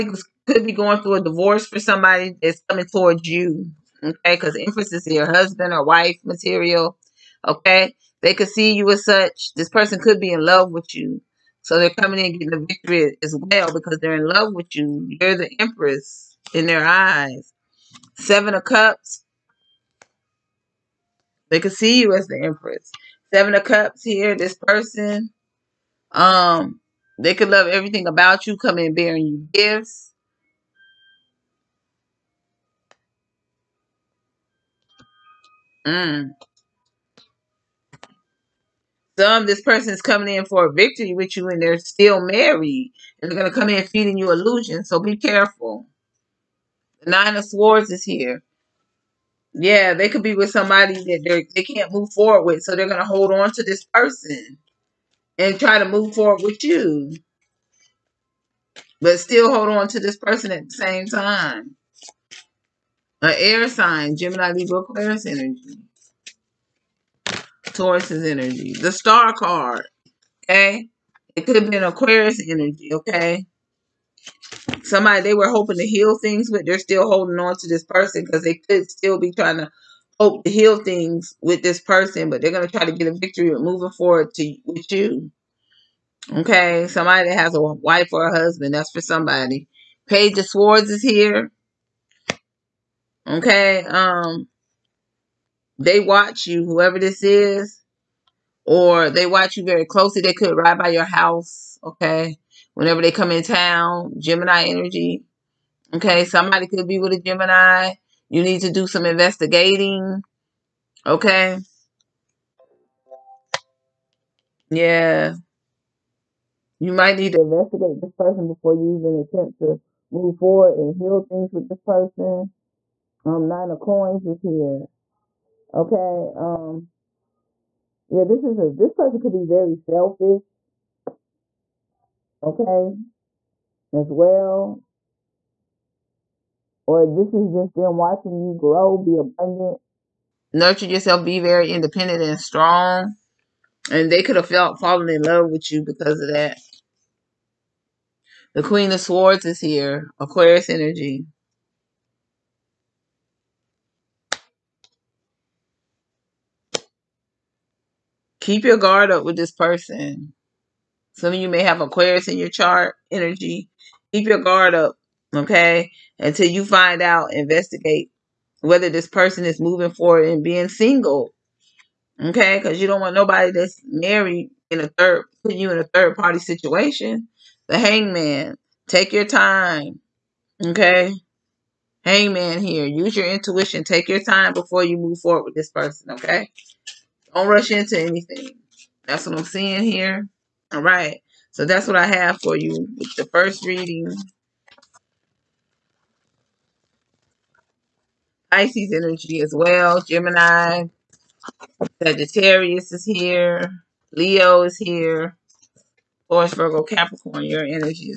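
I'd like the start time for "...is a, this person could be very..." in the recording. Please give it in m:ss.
2:08.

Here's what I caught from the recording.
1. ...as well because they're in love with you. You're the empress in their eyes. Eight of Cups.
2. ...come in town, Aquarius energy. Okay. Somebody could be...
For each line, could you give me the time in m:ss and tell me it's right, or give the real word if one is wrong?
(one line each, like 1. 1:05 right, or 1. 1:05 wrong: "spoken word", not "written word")
1. 0:13 wrong: "Seven", not "Eight"
2. 1:43 wrong: "Gemini", not "Aquarius".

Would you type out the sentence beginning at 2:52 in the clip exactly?
Because you don't want nobody that's married in a third, putting you in a third party situation.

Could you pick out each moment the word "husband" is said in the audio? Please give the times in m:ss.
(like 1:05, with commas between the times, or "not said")
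0:05, 1:28.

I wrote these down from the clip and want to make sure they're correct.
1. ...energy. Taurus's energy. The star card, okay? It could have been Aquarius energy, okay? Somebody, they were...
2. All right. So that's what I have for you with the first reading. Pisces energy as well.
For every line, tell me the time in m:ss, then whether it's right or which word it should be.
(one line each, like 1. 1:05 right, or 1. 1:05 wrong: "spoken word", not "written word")
1. 1:05 right
2. 3:10 right.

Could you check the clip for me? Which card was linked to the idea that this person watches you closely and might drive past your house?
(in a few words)
Page of Swords.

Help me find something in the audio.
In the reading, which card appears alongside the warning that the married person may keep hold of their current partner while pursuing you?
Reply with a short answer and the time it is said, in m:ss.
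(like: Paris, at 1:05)
Nine of Swords, at 0:47.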